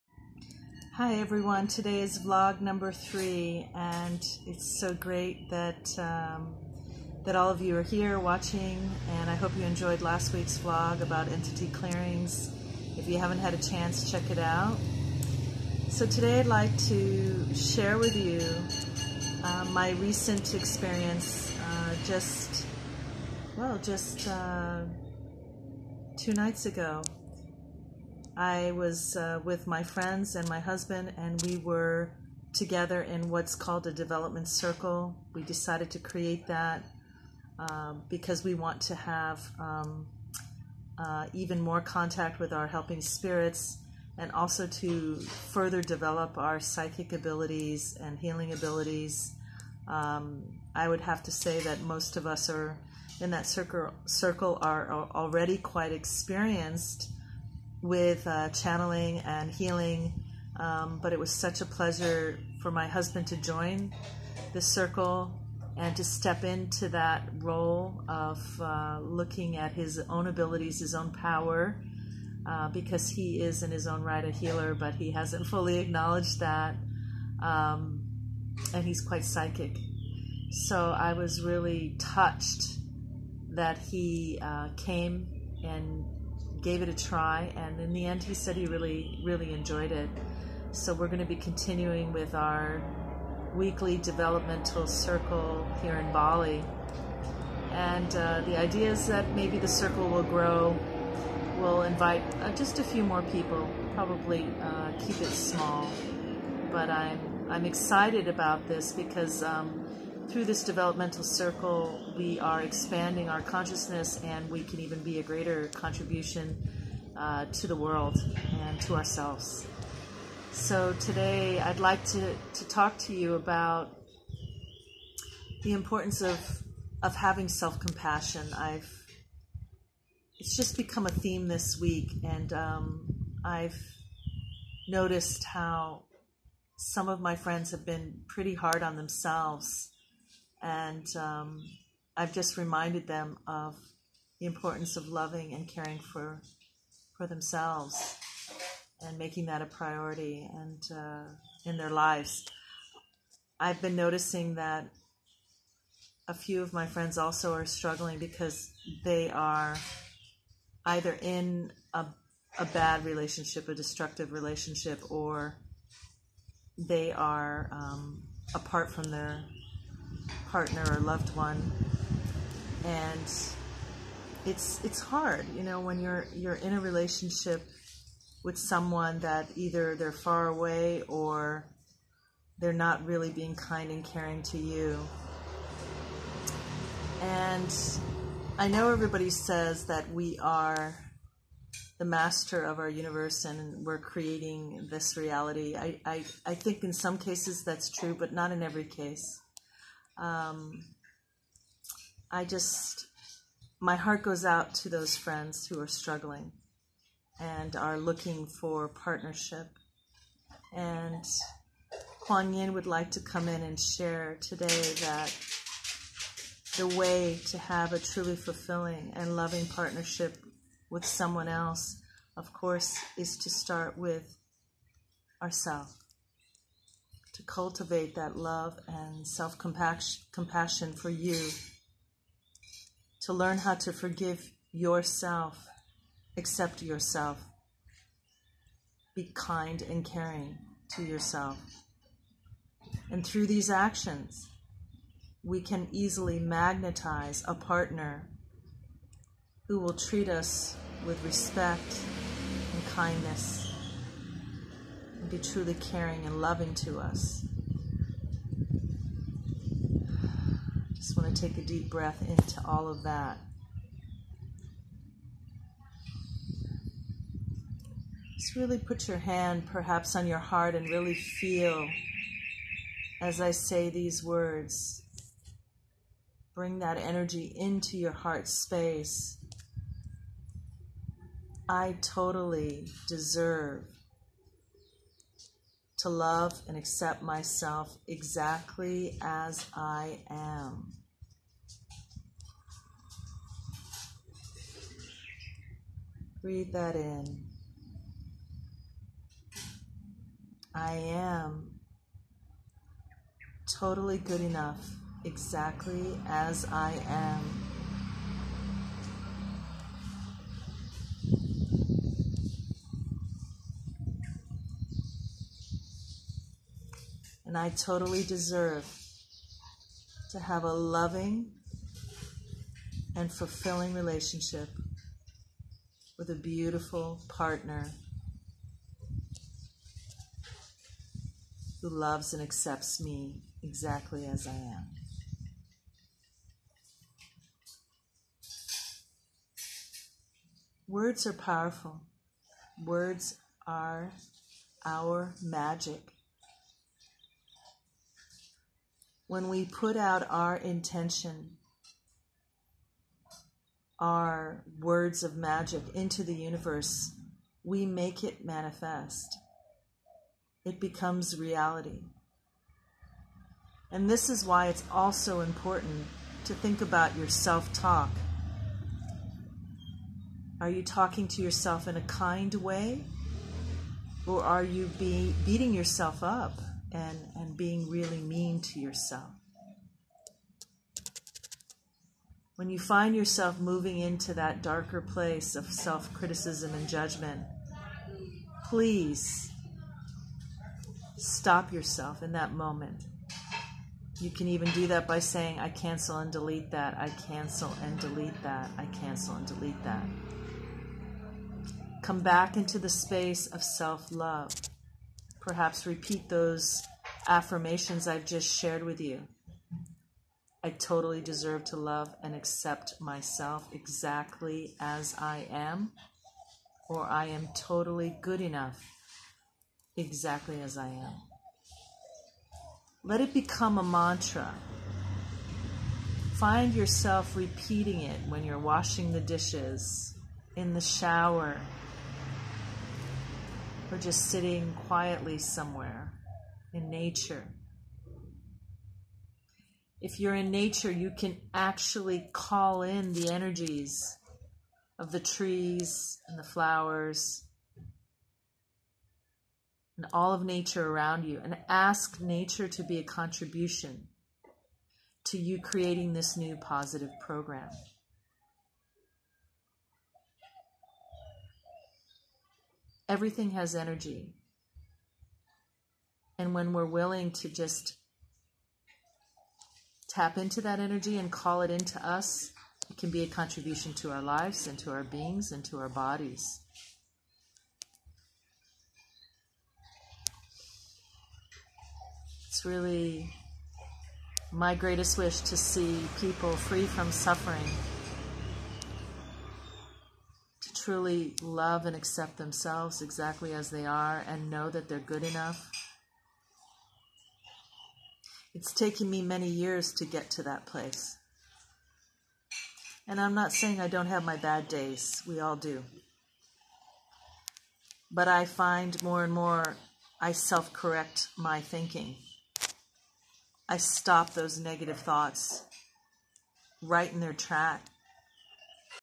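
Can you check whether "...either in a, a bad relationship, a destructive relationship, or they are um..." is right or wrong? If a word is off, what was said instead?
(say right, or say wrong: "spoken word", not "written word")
right.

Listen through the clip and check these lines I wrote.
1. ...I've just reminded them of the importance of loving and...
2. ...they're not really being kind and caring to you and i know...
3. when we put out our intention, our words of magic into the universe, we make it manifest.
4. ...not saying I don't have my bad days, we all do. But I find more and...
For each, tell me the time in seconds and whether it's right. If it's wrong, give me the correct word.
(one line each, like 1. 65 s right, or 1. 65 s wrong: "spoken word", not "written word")
1. 142 s right
2. 182 s right
3. 349 s right
4. 503 s right.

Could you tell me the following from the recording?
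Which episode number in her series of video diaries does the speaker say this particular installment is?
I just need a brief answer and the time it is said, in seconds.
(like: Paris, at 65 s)
3, at 2 s.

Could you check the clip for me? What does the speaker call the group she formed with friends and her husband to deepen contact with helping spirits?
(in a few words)
development circle.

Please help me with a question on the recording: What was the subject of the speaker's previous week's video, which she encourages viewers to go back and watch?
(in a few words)
entity clearings.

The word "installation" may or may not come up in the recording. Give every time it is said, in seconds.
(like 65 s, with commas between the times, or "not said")
not said.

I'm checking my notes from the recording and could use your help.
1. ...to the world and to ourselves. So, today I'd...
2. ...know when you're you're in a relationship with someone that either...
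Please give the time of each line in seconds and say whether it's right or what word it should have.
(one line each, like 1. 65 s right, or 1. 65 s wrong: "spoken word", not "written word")
1. 117 s right
2. 175 s right.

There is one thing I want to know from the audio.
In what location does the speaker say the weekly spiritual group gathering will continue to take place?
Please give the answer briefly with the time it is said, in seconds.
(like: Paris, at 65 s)
Bali, at 96 s.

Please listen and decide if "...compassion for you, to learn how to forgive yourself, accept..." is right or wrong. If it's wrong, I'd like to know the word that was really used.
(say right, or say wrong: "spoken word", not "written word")
right.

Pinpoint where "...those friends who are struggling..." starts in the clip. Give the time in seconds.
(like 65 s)
204 s.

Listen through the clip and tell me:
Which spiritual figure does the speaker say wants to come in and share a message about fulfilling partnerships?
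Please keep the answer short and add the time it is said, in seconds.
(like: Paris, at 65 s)
Kuan Yin, at 212 s.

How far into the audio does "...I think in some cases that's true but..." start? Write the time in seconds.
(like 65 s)
196 s.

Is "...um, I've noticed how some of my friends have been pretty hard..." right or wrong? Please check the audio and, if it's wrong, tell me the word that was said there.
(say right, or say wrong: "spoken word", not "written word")
right.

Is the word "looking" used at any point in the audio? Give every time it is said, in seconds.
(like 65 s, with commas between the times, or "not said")
69 s, 207 s.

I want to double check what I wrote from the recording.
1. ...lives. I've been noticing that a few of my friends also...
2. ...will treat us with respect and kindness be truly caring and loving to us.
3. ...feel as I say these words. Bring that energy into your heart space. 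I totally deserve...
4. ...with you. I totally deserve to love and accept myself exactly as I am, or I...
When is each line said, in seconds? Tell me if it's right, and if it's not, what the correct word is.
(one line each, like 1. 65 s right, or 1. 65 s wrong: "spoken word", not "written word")
1. 151 s right
2. 249 s right
3. 271 s right
4. 408 s right.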